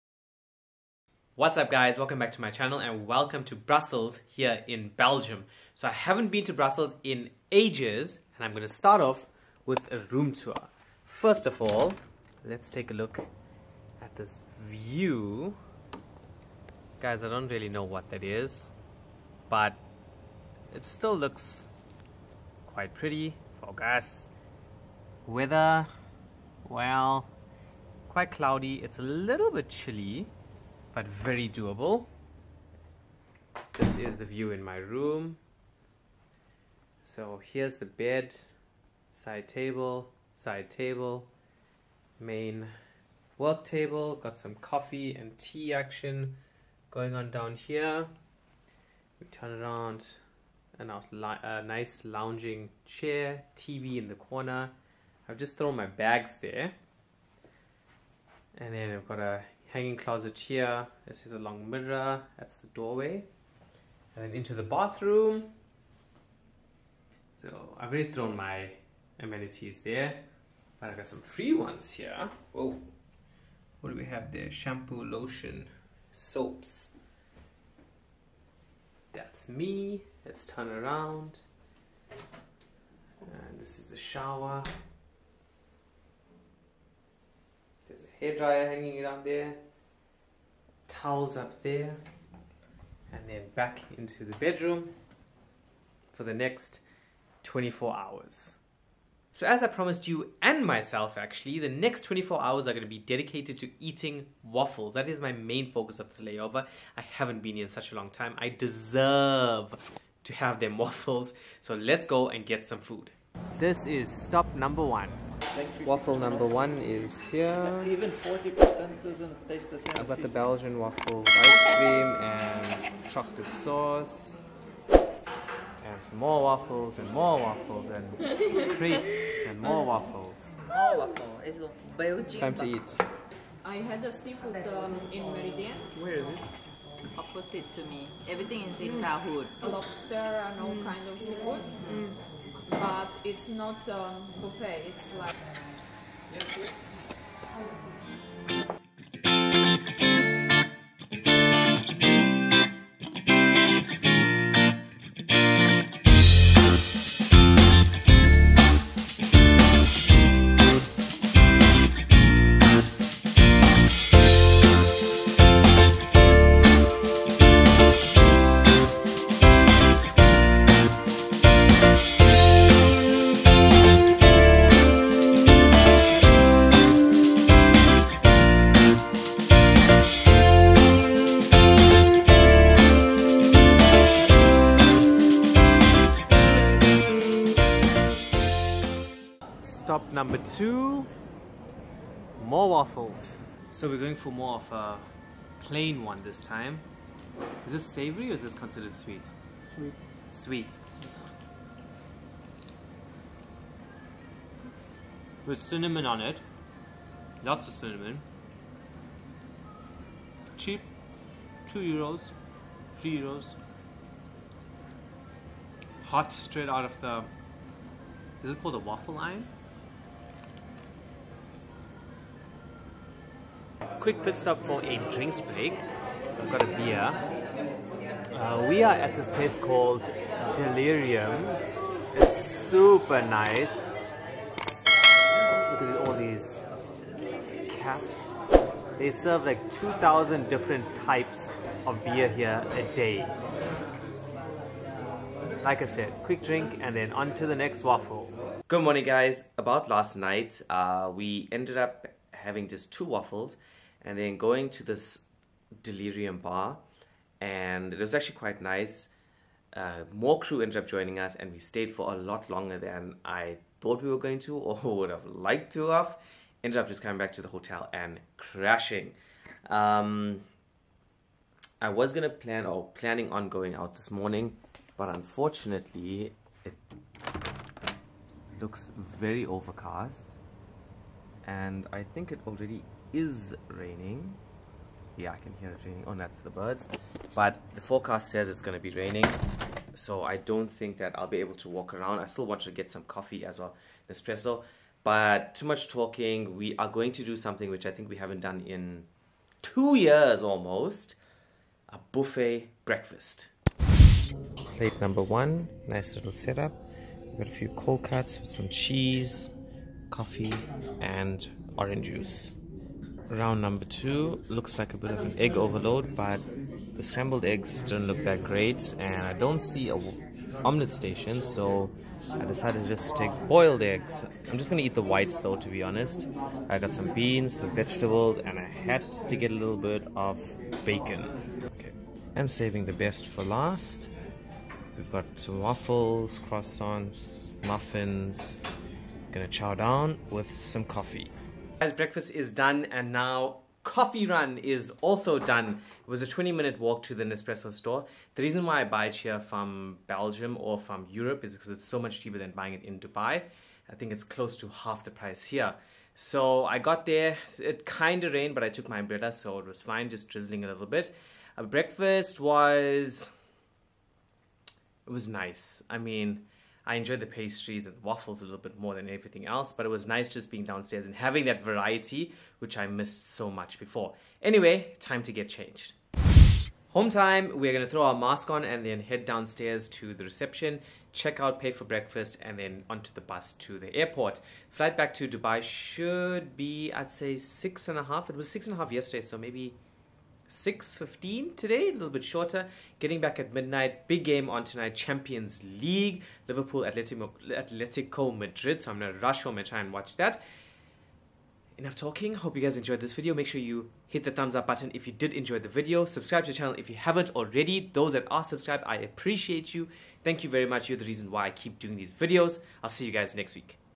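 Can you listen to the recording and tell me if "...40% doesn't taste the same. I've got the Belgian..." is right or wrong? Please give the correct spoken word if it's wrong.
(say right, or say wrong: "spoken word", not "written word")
right.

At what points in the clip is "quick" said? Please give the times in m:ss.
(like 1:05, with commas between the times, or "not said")
3:44, 4:06.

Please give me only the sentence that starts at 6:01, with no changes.
Uh, breakfast was, it was nice.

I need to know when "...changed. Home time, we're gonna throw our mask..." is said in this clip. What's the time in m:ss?
6:15.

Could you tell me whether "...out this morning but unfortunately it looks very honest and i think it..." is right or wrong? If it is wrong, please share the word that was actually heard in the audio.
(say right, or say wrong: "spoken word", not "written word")
wrong: "overcast", not "honest".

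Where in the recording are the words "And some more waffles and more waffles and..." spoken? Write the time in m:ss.
2:04.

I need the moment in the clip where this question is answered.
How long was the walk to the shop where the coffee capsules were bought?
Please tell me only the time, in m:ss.
5:46.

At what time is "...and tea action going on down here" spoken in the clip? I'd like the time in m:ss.
0:45.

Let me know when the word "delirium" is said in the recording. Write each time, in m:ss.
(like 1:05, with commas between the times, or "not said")
3:50, 4:15.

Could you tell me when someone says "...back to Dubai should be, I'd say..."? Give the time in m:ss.
6:24.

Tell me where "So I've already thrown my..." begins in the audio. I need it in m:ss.
1:07.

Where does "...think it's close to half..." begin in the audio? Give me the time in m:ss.
5:53.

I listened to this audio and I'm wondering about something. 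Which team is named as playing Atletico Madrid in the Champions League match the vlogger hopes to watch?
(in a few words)
Liverpool.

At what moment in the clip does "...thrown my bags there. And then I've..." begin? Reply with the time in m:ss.
0:55.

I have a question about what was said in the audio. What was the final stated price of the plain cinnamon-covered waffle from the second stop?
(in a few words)
3 euros.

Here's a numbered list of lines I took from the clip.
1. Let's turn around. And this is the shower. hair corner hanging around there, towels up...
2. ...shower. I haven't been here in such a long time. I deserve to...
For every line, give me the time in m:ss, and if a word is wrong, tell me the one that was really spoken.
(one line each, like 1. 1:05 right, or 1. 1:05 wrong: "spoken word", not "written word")
1. 1:20 wrong: "dryer", not "corner"
2. 1:46 wrong: "layover", not "shower".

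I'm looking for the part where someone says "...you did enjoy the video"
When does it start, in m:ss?
6:45.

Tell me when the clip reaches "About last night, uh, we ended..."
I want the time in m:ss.
4:09.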